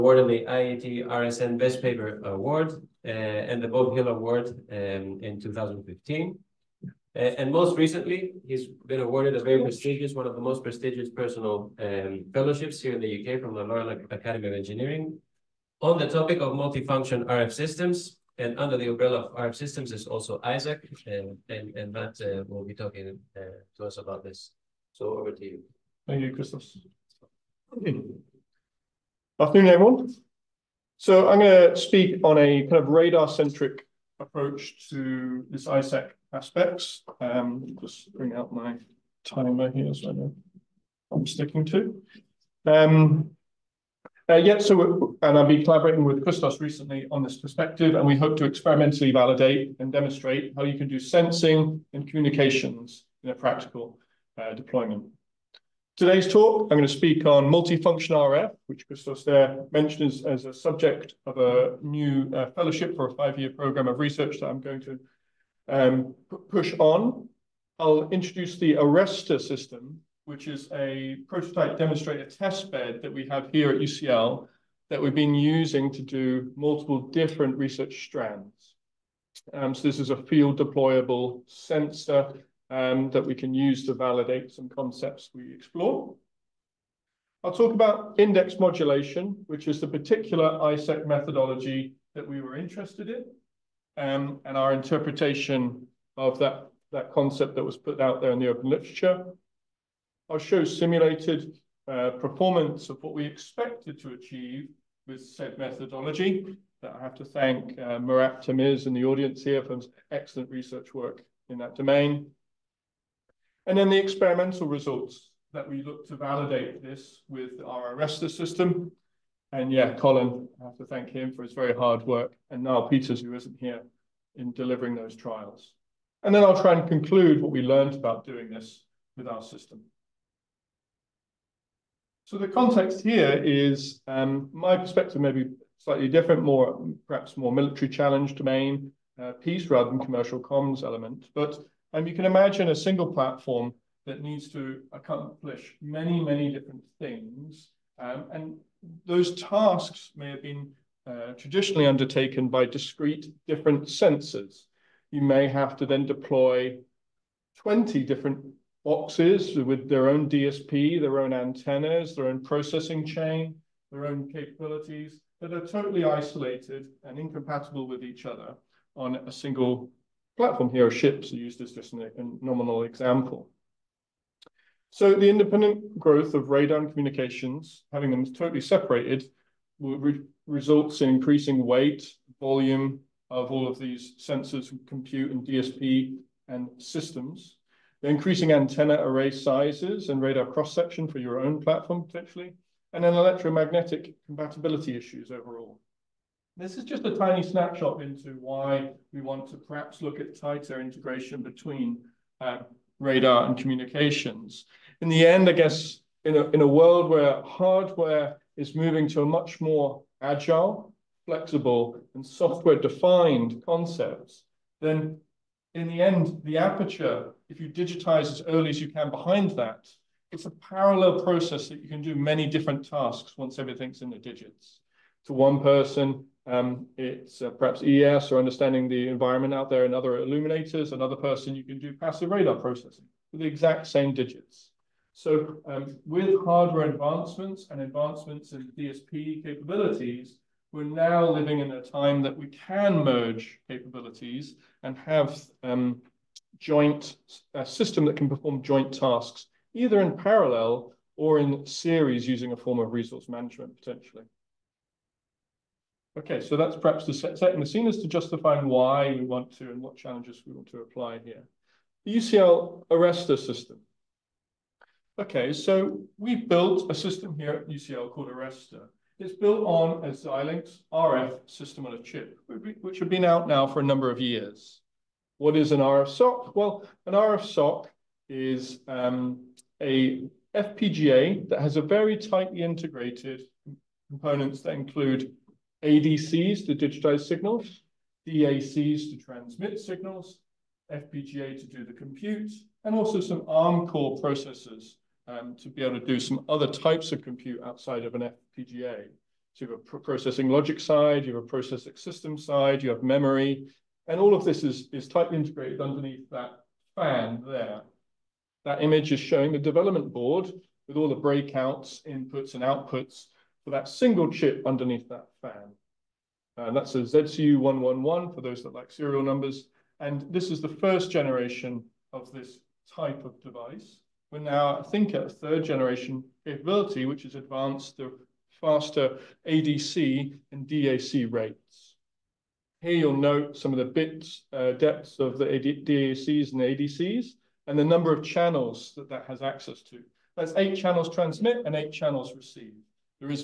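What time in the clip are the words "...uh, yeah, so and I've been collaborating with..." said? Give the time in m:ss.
0:44.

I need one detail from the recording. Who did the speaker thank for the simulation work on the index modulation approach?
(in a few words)
Murat Temiz.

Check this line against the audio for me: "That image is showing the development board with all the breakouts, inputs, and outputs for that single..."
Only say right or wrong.
right.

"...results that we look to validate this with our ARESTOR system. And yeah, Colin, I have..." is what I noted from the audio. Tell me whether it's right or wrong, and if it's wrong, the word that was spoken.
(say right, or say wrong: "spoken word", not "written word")
right.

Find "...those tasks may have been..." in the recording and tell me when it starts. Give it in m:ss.
2:29.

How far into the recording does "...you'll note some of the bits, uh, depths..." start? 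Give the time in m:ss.
5:32.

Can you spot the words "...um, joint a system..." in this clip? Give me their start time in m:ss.
4:05.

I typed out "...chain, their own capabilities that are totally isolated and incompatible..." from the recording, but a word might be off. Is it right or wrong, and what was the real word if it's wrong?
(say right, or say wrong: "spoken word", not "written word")
right.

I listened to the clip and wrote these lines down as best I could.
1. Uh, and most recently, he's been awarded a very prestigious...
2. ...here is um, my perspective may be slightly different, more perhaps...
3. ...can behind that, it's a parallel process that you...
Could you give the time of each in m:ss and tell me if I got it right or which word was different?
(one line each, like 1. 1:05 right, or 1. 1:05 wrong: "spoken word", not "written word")
1. 0:07 right
2. 2:13 right
3. 3:38 right.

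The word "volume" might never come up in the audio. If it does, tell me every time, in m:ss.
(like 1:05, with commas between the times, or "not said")
3:02.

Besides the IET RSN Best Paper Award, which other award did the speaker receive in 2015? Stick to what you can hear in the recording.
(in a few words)
Bob Hill Award.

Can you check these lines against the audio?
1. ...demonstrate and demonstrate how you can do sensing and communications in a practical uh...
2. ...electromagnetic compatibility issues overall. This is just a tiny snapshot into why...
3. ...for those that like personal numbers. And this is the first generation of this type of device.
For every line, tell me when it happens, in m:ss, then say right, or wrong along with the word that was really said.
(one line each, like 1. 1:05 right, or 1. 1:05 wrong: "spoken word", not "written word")
1. 0:49 wrong: "validate", not "demonstrate"
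2. 3:13 right
3. 5:18 wrong: "serial", not "personal".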